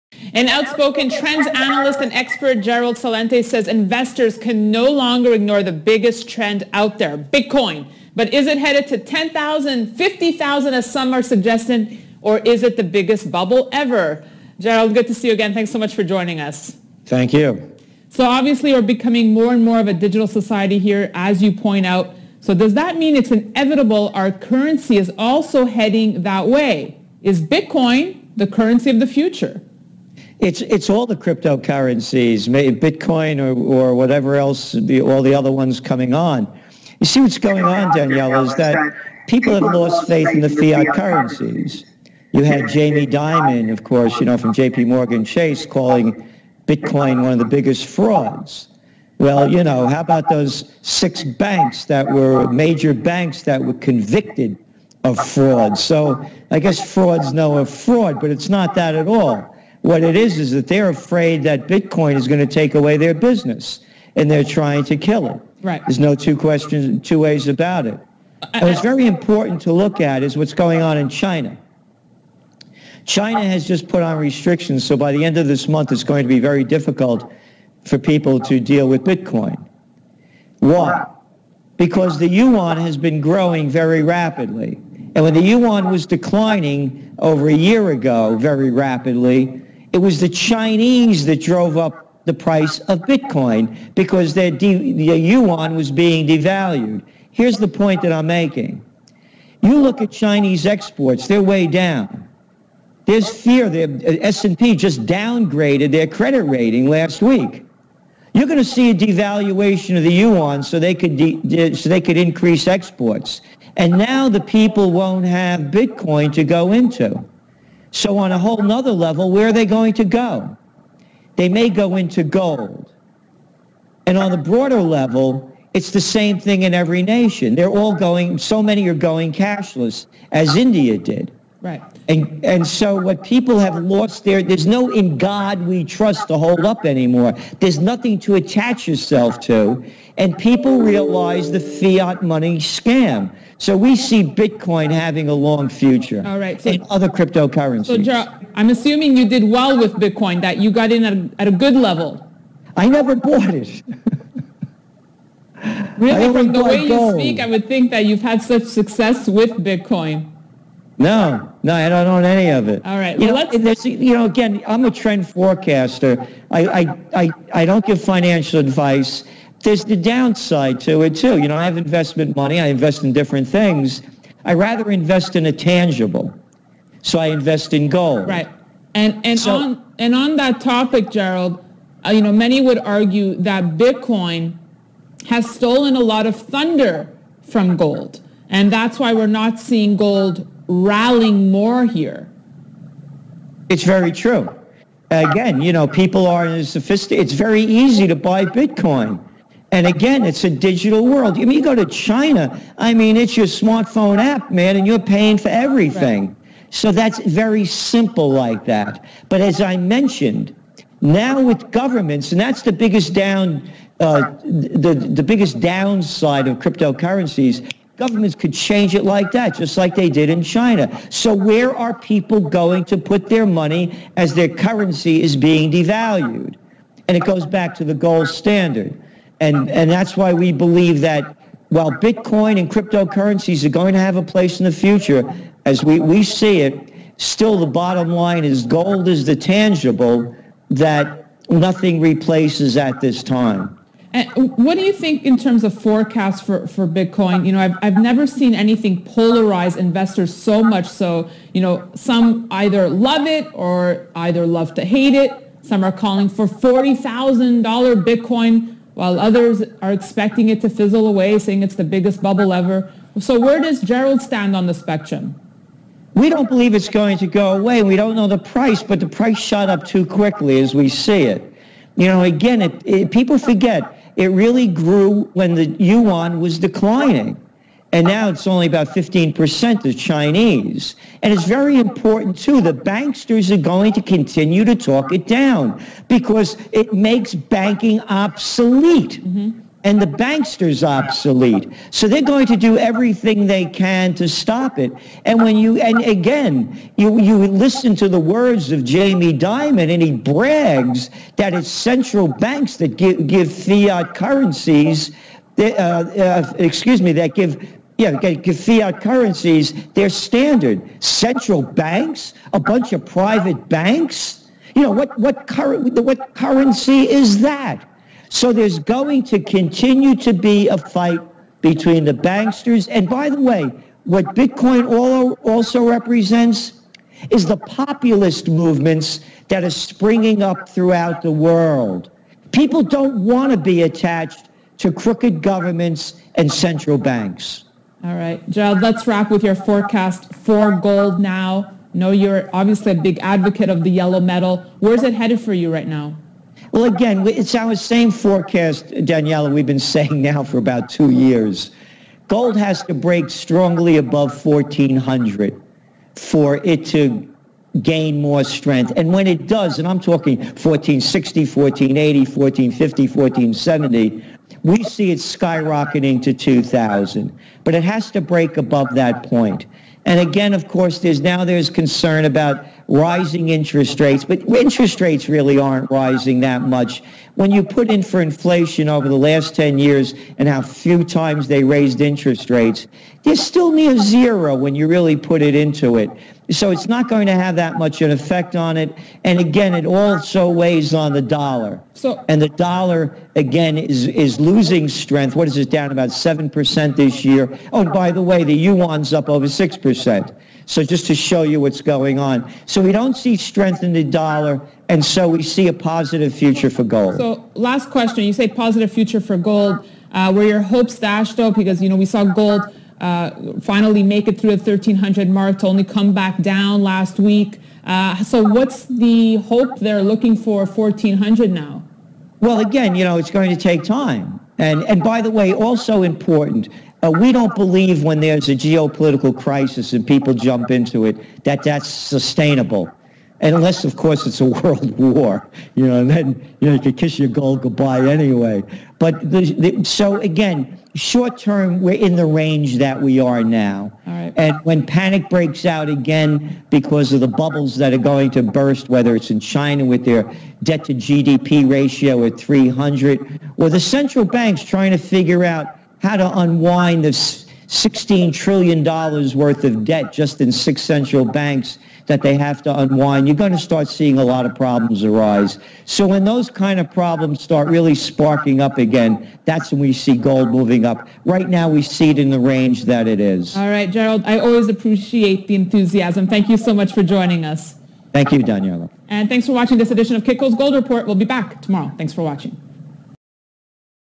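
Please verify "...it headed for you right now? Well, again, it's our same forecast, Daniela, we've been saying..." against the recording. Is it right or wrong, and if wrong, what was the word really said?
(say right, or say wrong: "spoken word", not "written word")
right.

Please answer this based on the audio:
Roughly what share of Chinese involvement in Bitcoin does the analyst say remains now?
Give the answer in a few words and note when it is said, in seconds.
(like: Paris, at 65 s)
15%, at 278 s.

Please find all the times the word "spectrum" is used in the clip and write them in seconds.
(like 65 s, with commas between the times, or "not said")
264 s.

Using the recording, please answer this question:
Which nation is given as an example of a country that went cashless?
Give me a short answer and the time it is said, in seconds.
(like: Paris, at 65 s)
India, at 130 s.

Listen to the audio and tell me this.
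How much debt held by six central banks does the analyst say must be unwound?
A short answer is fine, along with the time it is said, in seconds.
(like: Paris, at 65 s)
$16 trillion, at 457 s.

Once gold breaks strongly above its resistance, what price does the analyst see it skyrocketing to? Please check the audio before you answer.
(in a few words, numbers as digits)
2000.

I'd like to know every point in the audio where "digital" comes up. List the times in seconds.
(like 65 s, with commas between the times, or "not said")
19 s, 200 s.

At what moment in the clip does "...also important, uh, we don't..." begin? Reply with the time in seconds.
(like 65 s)
425 s.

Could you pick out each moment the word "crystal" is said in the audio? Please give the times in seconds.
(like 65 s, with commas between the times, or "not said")
not said.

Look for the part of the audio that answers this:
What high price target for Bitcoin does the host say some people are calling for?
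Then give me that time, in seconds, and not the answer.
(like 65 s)
256 s.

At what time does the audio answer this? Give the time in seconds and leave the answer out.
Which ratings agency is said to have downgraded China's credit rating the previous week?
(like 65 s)
104 s.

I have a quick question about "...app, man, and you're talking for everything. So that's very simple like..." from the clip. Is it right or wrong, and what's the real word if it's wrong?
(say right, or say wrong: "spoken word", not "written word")
wrong: "paying", not "talking".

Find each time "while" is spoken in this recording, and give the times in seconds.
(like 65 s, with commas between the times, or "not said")
231 s, 258 s.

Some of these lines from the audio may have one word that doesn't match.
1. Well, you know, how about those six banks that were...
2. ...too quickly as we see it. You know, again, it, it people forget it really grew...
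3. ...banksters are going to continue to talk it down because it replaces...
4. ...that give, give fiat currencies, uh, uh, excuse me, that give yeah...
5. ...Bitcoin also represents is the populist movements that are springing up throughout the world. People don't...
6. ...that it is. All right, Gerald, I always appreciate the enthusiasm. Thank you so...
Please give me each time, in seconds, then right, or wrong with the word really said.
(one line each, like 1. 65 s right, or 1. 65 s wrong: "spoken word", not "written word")
1. 49 s right
2. 269 s right
3. 282 s wrong: "makes", not "replaces"
4. 302 s right
5. 324 s right
6. 472 s right.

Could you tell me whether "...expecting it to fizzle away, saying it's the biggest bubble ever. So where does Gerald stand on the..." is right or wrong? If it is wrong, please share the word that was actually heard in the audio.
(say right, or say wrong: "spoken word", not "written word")
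right.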